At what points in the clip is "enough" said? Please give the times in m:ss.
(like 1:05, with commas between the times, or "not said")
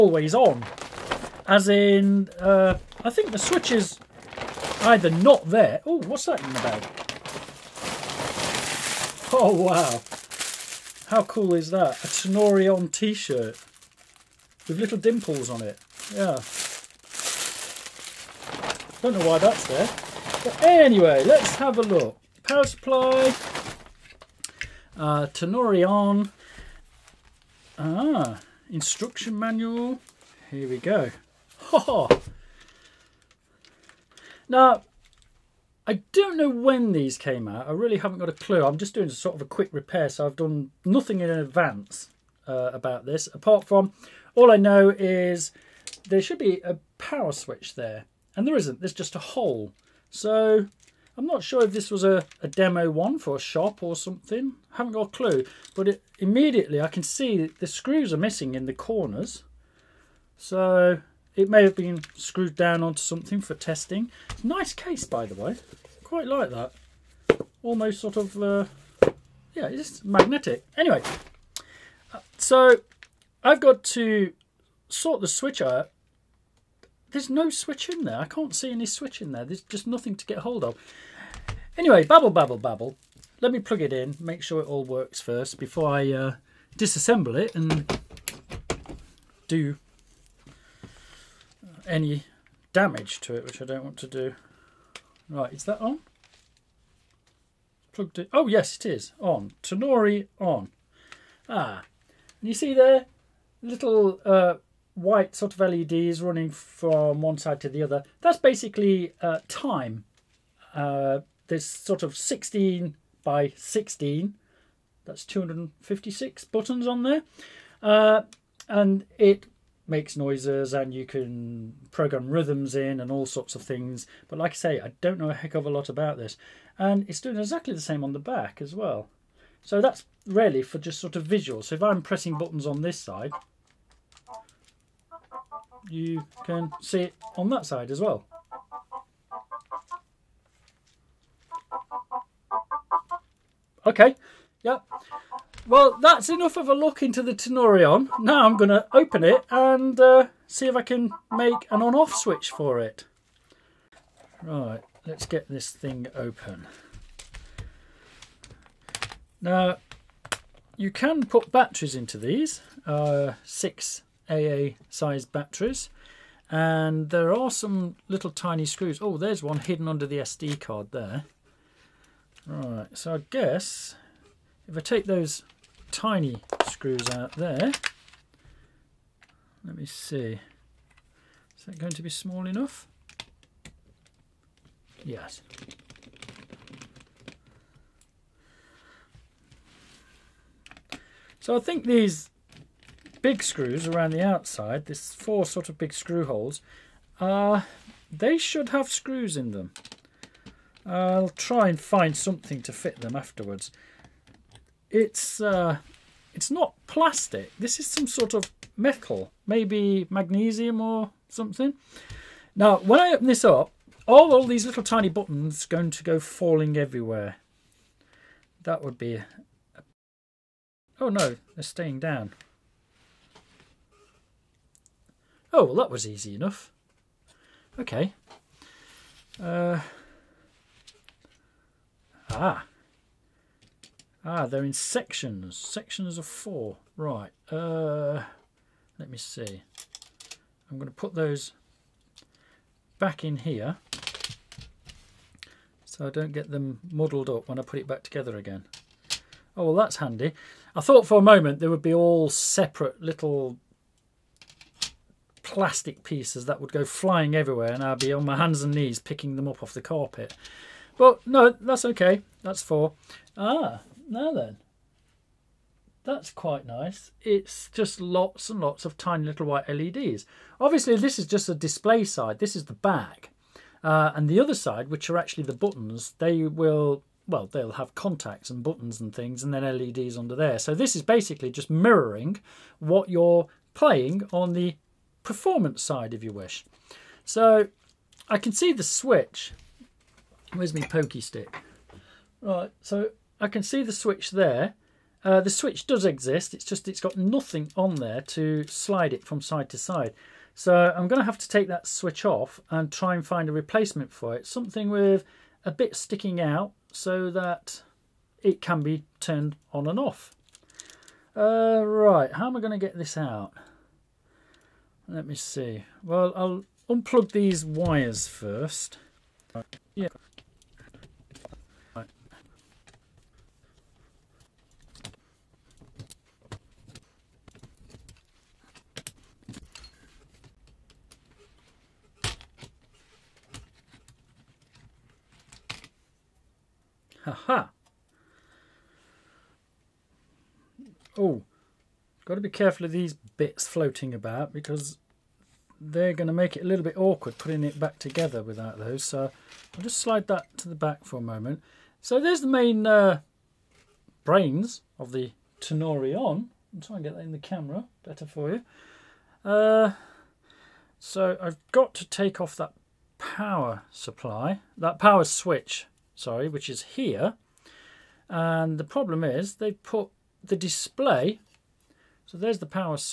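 2:26, 3:02, 3:46.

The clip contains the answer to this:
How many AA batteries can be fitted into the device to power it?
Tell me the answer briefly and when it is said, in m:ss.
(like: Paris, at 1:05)
6, at 2:43.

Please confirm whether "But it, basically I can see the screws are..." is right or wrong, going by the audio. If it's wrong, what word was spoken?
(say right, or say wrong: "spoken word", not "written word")
wrong: "immediately", not "basically".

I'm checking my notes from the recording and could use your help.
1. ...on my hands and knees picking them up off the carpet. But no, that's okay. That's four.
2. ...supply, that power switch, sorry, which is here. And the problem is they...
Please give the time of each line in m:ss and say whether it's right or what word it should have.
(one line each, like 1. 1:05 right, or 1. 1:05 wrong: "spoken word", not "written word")
1. 4:18 right
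2. 6:03 right.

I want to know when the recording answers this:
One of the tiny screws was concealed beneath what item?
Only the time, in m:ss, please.
2:50.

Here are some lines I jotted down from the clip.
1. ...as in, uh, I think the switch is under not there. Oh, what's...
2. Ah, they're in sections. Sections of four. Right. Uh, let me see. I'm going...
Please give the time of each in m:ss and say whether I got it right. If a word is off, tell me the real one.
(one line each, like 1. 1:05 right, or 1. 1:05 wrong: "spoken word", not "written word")
1. 0:01 wrong: "either", not "under"
2. 3:54 right.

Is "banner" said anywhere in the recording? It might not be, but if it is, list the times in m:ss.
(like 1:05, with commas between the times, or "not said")
not said.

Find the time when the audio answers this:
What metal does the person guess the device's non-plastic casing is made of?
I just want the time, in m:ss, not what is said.
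3:30.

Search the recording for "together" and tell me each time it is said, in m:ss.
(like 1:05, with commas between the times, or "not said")
4:08, 5:47.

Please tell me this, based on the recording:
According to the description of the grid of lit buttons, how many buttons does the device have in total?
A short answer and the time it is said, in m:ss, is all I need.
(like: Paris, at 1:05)
256, at 1:55.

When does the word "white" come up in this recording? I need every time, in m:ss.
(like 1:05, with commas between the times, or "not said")
1:44, 4:29.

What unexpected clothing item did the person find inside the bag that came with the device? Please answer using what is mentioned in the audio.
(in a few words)
A Tenori-on t-shirt.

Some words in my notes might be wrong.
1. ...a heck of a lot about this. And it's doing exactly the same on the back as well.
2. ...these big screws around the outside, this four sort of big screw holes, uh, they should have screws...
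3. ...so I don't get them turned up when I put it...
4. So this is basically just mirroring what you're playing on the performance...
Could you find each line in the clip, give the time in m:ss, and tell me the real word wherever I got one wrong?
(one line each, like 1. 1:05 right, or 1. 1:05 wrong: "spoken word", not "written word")
1. 2:05 right
2. 3:11 right
3. 4:05 wrong: "muddled", not "turned"
4. 4:40 right.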